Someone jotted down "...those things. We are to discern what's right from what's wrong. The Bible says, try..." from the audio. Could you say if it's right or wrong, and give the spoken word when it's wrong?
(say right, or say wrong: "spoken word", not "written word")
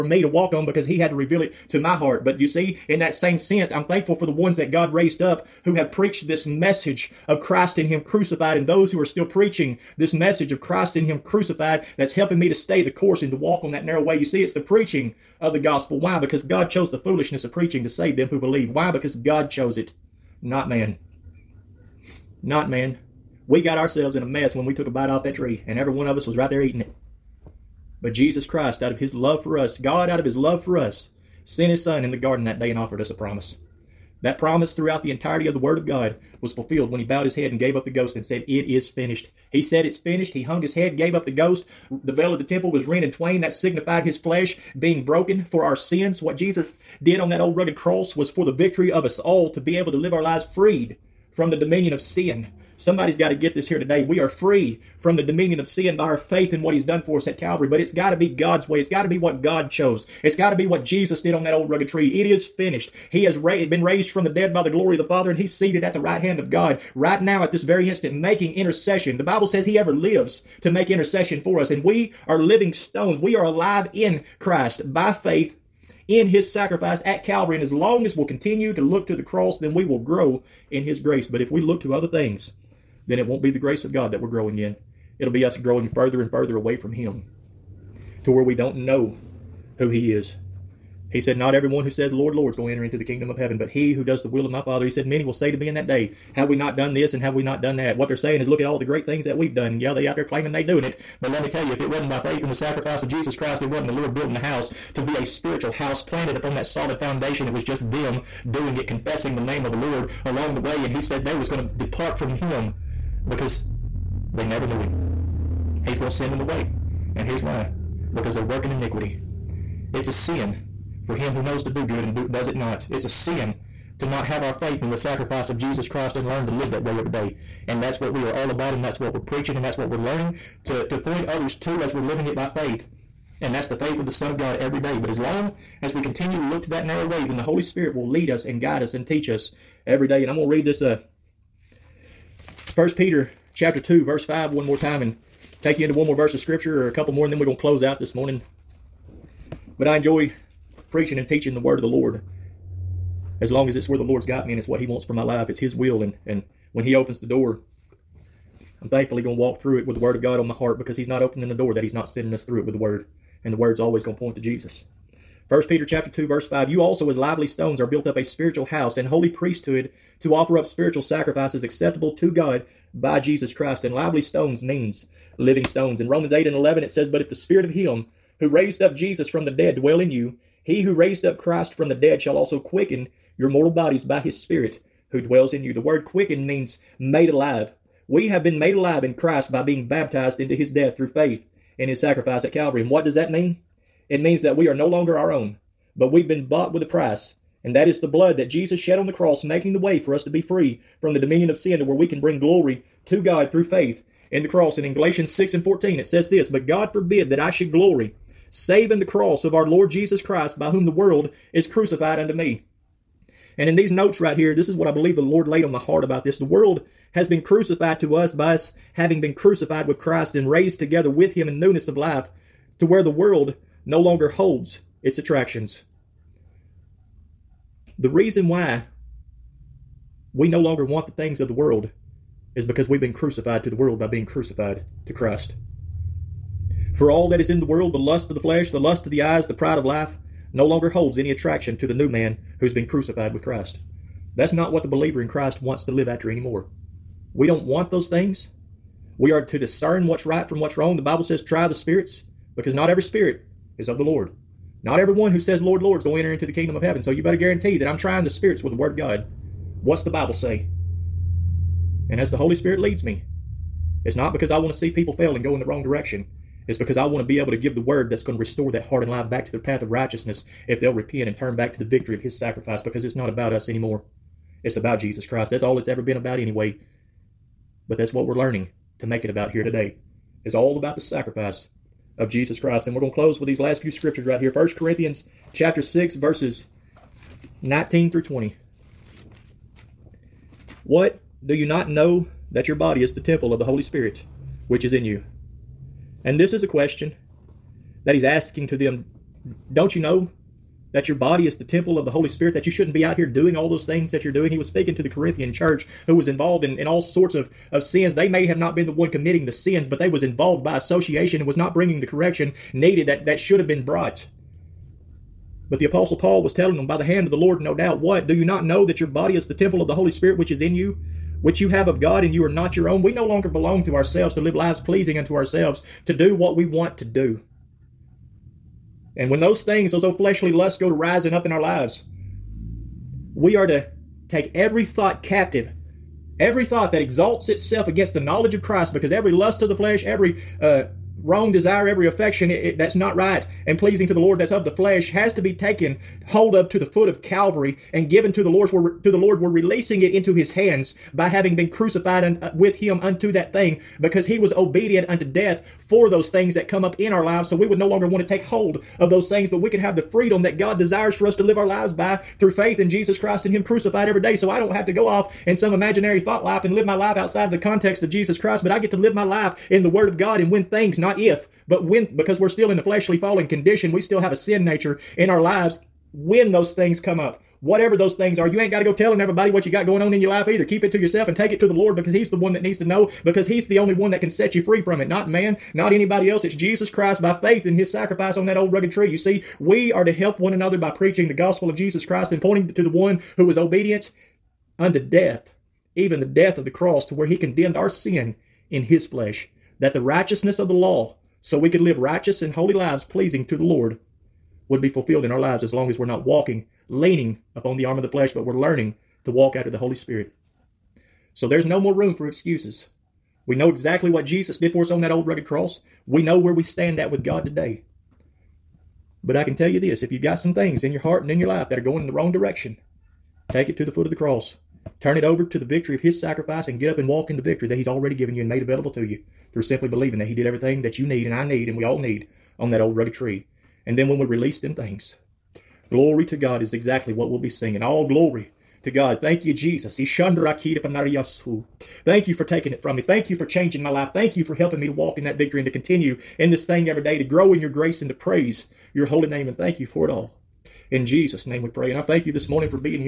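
right.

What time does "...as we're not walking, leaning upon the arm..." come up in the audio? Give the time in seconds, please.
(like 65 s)
405 s.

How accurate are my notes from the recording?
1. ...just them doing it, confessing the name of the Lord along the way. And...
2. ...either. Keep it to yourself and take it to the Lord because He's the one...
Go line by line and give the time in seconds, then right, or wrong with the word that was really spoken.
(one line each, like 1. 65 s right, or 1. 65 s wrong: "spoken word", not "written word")
1. 107 s right
2. 380 s right.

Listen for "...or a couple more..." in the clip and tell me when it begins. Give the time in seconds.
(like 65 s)
146 s.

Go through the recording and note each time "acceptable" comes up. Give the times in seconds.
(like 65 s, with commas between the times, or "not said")
171 s.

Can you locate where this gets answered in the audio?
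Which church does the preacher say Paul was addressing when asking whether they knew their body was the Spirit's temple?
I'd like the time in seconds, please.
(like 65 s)
305 s.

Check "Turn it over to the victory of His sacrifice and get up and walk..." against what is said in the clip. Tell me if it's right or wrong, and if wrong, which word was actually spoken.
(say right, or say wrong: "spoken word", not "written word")
right.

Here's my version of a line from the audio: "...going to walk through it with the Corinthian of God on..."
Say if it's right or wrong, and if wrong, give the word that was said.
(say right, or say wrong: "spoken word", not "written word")
wrong: "Word", not "Corinthian".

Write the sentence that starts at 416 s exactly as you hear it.
We know where we stand at with God today.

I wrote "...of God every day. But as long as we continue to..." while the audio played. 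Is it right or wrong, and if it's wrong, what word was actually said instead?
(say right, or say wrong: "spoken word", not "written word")
right.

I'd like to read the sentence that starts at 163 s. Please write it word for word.
And the Word's always going to point to Jesus.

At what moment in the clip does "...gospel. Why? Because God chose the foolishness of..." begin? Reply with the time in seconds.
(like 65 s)
15 s.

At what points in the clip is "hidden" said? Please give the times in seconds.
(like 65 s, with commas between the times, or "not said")
not said.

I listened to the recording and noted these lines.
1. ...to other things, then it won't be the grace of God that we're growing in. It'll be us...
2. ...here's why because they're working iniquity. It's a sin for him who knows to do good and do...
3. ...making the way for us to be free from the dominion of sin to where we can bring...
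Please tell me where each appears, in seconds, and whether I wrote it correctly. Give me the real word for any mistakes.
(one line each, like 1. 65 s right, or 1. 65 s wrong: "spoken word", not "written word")
1. 81 s right
2. 117 s right
3. 199 s right.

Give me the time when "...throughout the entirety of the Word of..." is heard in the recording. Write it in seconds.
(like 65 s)
34 s.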